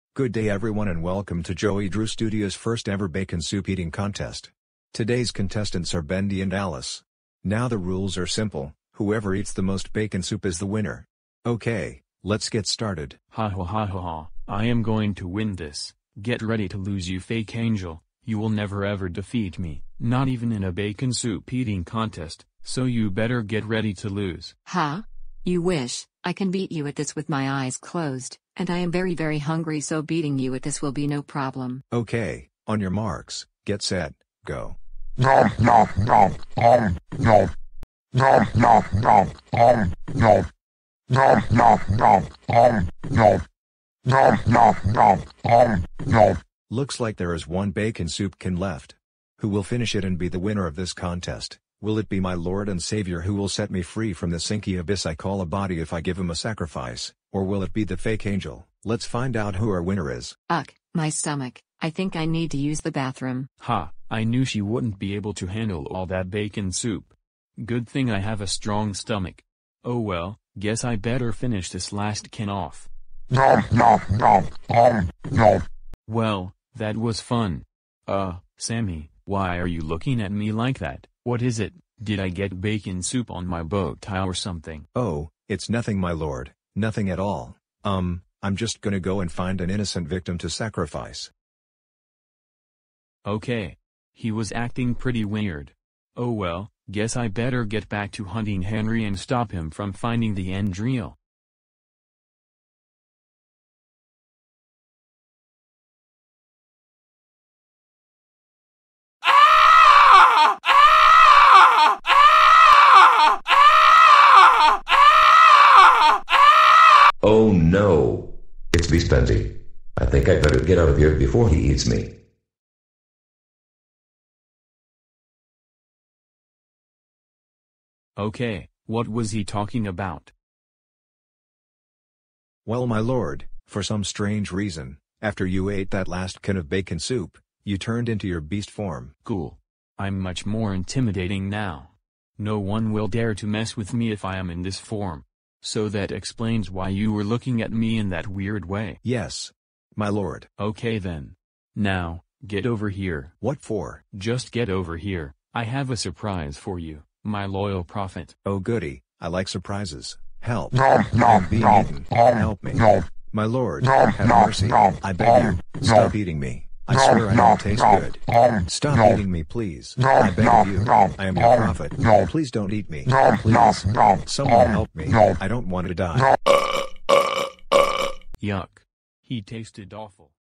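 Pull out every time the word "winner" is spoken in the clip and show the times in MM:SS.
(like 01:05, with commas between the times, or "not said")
00:10, 00:50, 00:59.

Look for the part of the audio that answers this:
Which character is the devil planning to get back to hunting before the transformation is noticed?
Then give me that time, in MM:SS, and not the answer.
01:38.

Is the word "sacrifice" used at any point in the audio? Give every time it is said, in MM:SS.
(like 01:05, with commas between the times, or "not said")
00:56, 01:30.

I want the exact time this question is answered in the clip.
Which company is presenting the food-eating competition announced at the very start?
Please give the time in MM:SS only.
00:01.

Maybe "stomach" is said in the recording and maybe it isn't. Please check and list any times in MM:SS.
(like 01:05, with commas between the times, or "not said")
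01:01, 01:08.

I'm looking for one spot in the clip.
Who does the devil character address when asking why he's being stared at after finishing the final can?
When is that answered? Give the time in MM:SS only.
01:18.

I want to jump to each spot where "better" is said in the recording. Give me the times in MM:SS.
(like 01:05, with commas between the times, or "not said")
00:23, 01:10, 01:37, 02:00.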